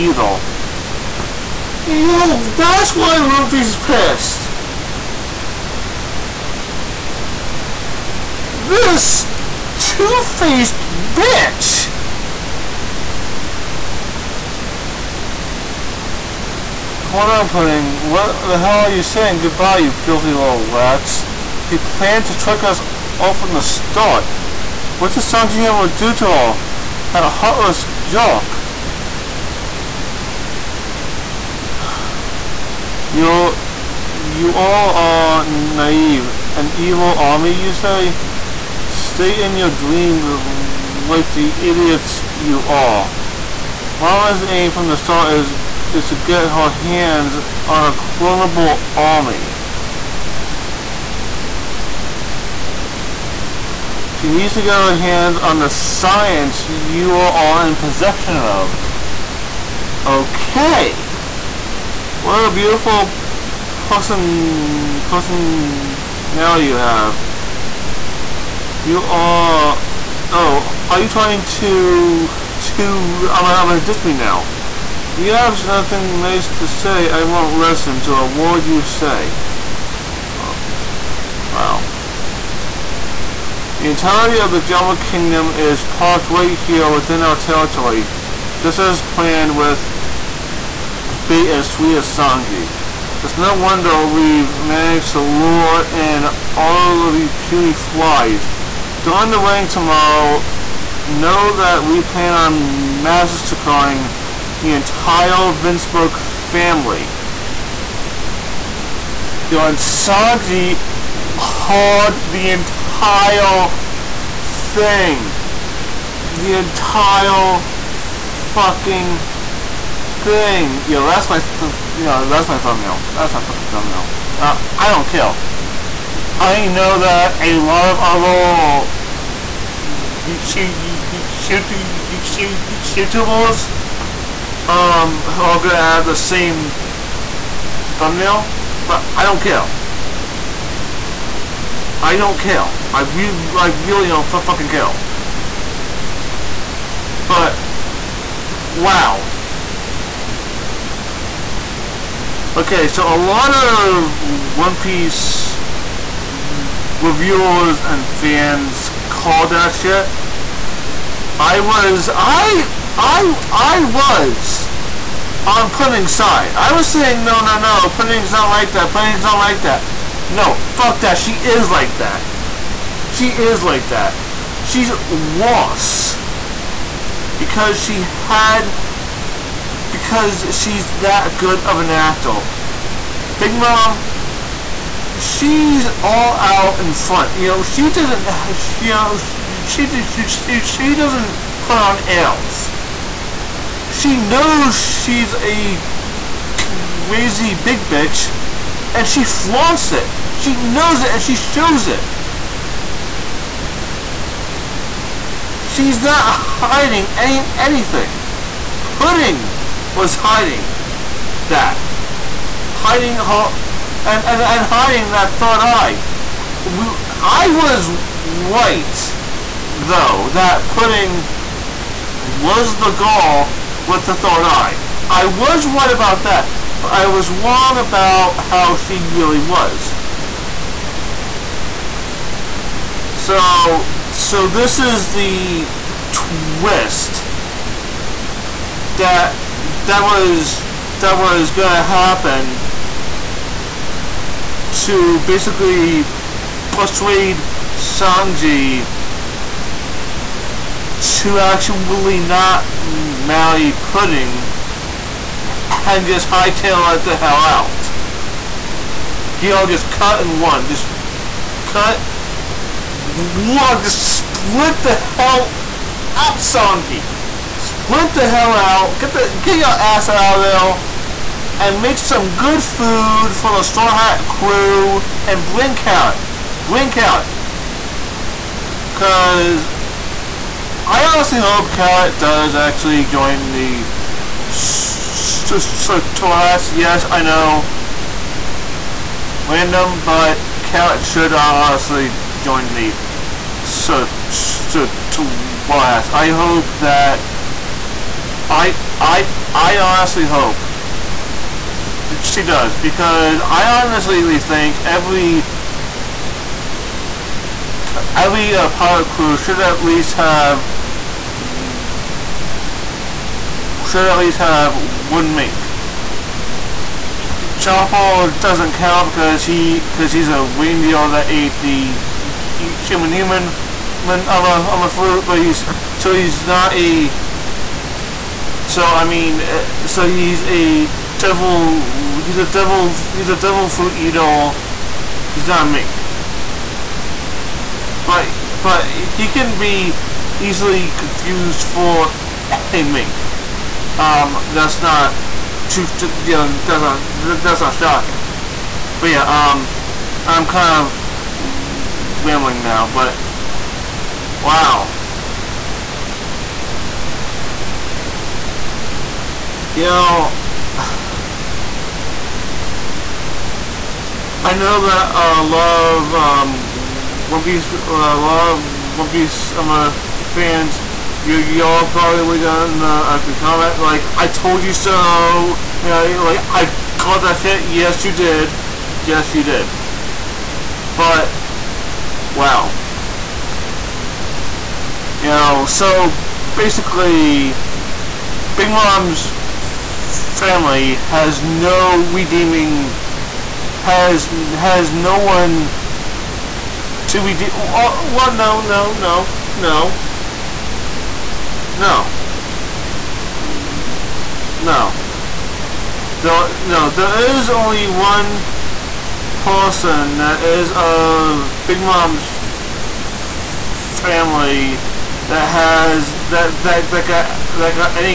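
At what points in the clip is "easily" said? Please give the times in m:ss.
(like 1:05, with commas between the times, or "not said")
5:40.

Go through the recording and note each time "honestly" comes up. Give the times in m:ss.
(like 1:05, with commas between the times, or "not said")
4:41, 4:51, 4:59, 5:03.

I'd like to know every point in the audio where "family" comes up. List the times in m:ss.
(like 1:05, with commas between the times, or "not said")
1:46, 6:29, 6:53.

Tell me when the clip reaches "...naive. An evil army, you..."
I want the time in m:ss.
0:35.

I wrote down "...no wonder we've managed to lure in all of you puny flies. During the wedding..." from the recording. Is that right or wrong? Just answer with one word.
right.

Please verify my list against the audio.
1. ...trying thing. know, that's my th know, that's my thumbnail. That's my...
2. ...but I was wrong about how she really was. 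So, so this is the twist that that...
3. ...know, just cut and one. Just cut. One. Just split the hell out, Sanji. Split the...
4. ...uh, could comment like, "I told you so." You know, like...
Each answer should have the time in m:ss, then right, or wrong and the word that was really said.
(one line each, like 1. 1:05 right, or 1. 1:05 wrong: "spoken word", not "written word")
1. 1:57 wrong: "fucking", not "trying"
2. 3:46 right
3. 4:19 right
4. 6:12 right.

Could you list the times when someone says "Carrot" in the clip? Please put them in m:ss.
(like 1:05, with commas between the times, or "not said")
4:41, 4:50.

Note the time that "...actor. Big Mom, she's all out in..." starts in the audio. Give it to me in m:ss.
3:01.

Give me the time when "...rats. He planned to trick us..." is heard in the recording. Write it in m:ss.
0:20.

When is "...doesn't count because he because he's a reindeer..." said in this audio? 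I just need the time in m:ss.
5:18.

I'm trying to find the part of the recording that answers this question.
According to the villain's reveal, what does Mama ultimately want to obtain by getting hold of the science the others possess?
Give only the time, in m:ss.
0:47.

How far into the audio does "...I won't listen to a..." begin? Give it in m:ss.
1:17.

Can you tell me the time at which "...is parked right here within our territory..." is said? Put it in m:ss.
1:25.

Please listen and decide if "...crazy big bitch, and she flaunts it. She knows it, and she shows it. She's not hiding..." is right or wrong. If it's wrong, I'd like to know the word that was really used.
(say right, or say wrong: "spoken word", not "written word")
right.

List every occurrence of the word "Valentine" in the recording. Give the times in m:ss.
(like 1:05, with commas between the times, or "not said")
not said.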